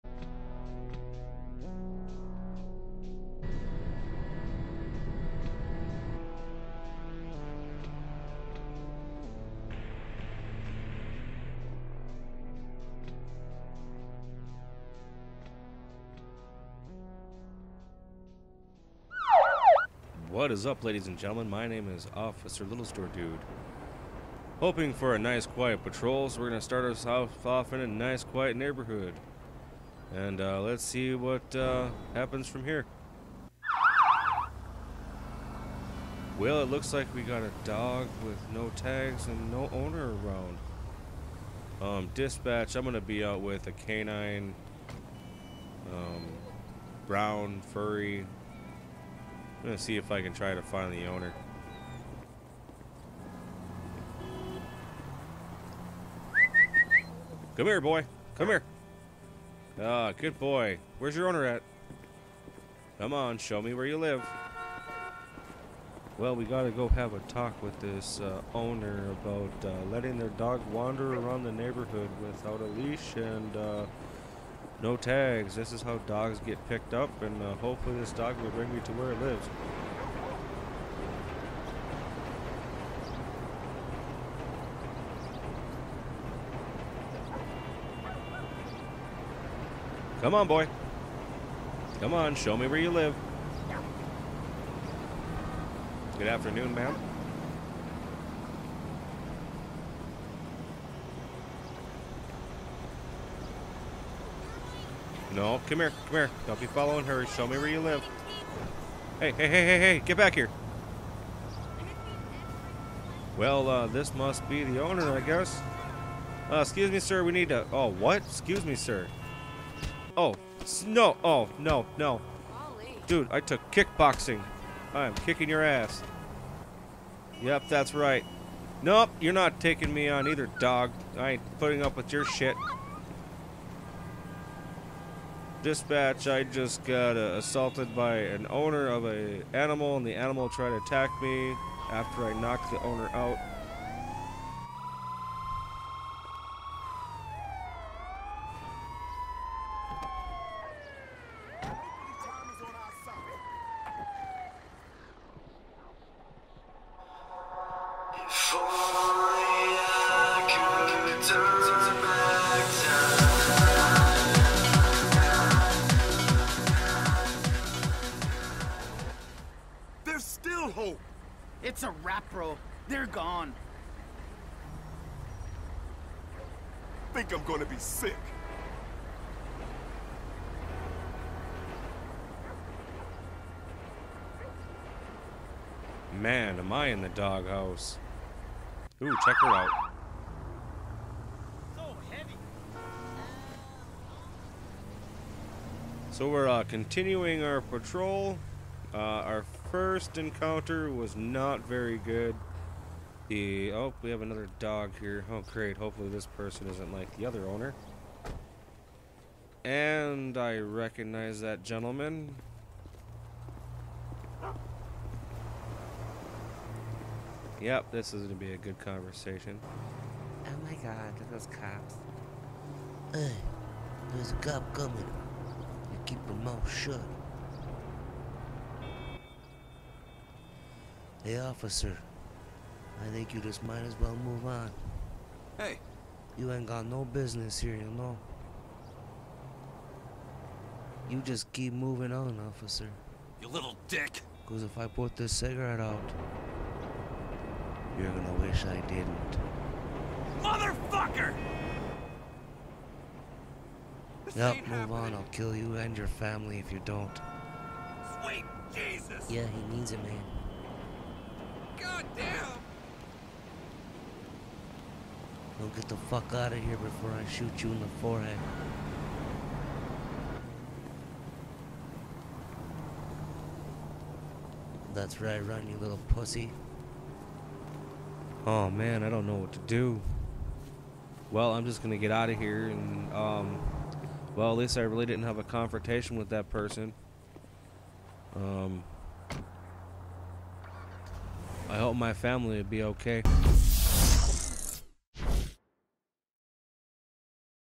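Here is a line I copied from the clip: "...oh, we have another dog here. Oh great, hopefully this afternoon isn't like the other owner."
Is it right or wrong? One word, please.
wrong.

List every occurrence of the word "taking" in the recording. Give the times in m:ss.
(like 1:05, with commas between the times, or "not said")
2:09.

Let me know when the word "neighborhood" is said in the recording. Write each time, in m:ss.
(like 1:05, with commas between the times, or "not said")
0:28, 1:11.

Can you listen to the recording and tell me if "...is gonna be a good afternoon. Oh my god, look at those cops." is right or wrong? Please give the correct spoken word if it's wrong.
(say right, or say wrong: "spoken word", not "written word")
wrong: "conversation", not "afternoon".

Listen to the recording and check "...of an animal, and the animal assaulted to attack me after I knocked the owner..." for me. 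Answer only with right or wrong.
wrong.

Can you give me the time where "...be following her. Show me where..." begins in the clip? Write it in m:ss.
1:46.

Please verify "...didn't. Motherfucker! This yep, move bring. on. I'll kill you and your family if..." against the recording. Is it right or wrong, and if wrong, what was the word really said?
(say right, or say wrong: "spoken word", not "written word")
wrong: "happening", not "bring".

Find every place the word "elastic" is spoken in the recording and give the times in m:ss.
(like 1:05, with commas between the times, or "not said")
not said.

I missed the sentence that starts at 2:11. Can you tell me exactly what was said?
I ain't putting up with your shit.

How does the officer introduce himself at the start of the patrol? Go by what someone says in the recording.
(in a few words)
Officer Little Store Dude.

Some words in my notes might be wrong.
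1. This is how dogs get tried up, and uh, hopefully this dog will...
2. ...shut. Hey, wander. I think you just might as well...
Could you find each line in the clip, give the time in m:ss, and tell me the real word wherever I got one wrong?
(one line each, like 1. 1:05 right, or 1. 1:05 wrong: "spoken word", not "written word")
1. 1:15 wrong: "picked", not "tried"
2. 3:46 wrong: "officer", not "wander".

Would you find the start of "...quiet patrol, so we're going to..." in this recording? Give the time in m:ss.
0:25.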